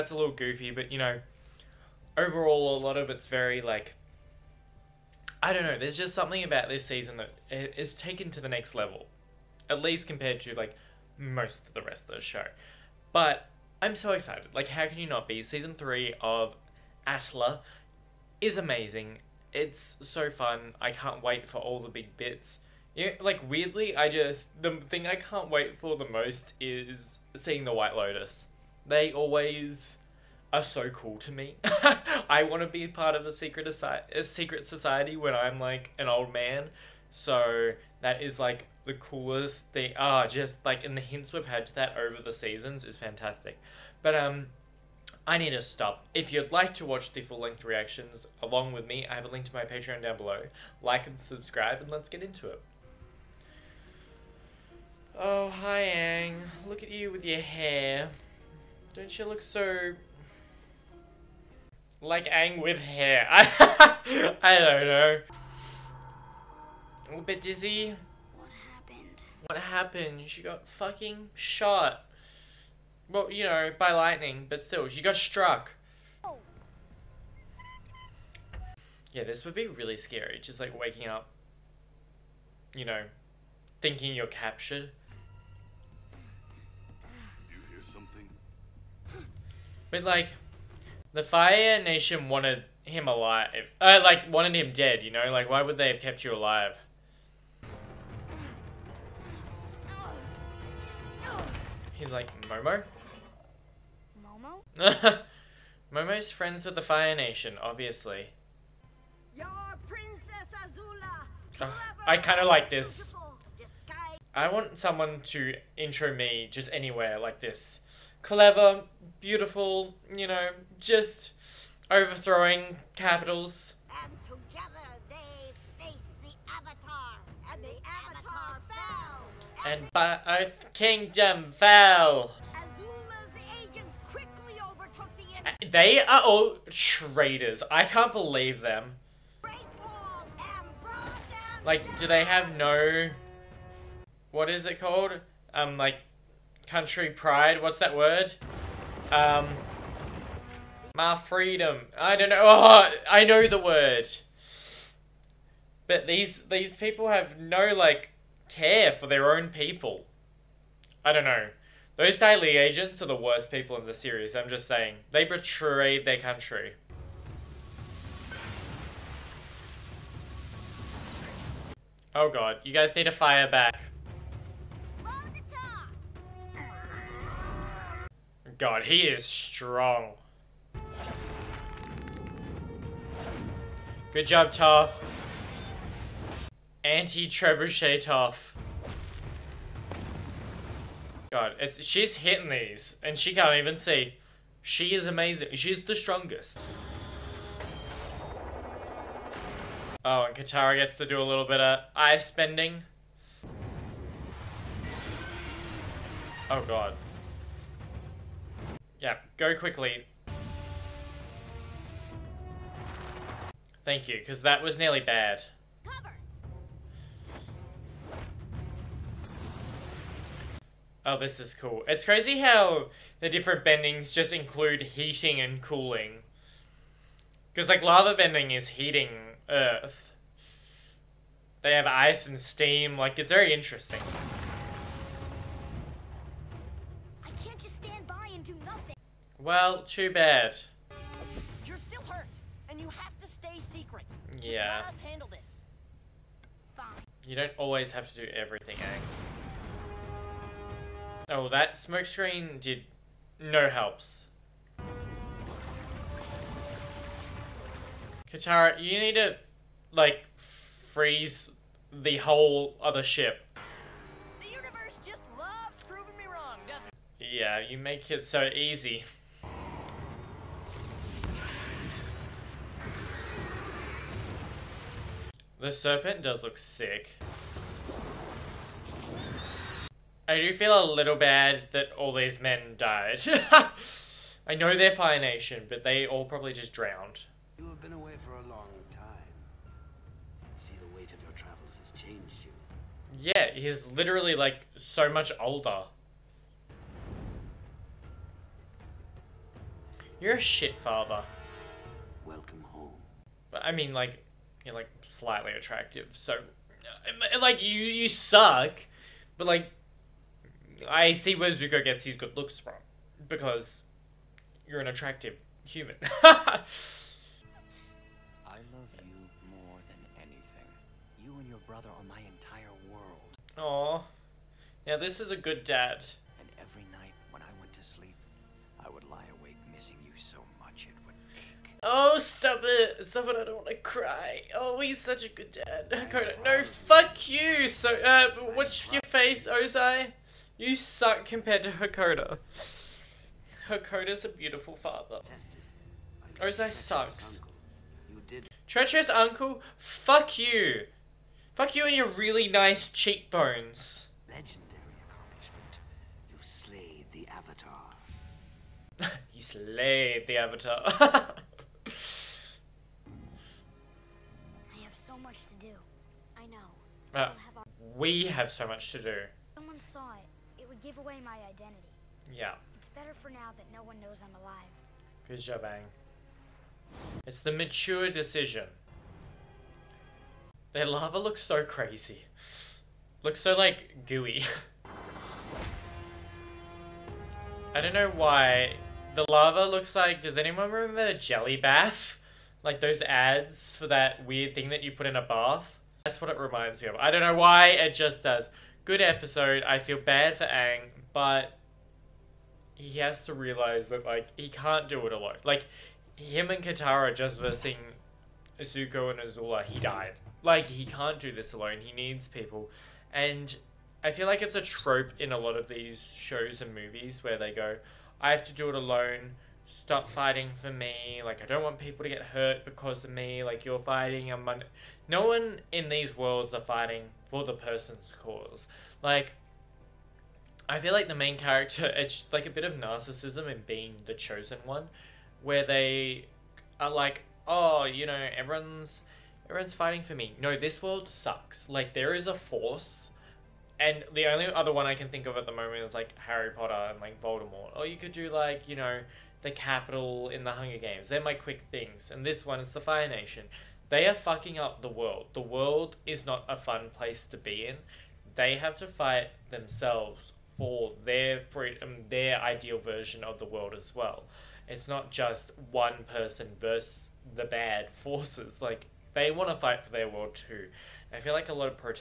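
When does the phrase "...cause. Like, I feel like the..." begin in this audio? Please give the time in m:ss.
7:08.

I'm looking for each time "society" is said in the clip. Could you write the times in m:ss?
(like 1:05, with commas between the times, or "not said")
0:34.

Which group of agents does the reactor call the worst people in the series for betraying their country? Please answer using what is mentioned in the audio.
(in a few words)
Dai Li agents.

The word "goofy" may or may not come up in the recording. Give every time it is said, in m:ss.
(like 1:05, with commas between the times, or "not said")
0:00.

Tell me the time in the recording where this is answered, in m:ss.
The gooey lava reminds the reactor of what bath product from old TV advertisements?
6:31.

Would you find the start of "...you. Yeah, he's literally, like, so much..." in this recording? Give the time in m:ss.
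4:52.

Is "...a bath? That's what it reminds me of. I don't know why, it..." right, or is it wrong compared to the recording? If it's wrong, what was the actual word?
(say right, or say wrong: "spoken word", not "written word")
right.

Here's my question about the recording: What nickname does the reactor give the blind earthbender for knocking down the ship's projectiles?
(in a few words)
Anti-trebuchet Toph.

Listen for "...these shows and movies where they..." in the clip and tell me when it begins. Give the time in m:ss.
6:55.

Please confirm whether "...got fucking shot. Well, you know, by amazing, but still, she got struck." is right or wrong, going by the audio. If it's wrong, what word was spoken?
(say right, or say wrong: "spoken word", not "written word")
wrong: "lightning", not "amazing".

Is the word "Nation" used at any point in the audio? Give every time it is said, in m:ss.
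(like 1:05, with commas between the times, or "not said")
1:31, 1:47, 4:45, 7:33.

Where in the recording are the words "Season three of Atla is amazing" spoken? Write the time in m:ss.
0:15.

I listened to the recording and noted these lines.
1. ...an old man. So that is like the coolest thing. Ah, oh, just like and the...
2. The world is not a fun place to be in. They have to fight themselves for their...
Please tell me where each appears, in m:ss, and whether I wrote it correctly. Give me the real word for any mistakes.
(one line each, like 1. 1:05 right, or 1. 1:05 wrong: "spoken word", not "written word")
1. 0:35 right
2. 7:35 right.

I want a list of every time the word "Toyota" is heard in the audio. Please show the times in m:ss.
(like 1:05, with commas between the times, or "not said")
not said.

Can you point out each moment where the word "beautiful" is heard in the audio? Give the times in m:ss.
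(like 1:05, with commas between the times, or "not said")
1:59, 5:44.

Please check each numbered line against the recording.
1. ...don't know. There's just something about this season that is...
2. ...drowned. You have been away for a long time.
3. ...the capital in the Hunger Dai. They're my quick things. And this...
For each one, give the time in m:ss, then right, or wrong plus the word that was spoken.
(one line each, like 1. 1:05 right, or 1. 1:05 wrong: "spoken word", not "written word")
1. 0:05 right
2. 4:46 right
3. 7:29 wrong: "Games", not "Dai".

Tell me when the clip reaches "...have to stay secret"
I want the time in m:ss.
4:02.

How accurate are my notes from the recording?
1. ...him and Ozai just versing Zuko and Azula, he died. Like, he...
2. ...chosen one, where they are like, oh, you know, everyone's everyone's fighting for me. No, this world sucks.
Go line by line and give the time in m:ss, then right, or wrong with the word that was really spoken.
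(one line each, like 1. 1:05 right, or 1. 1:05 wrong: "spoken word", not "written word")
1. 6:46 wrong: "Katara", not "Ozai"
2. 7:14 right.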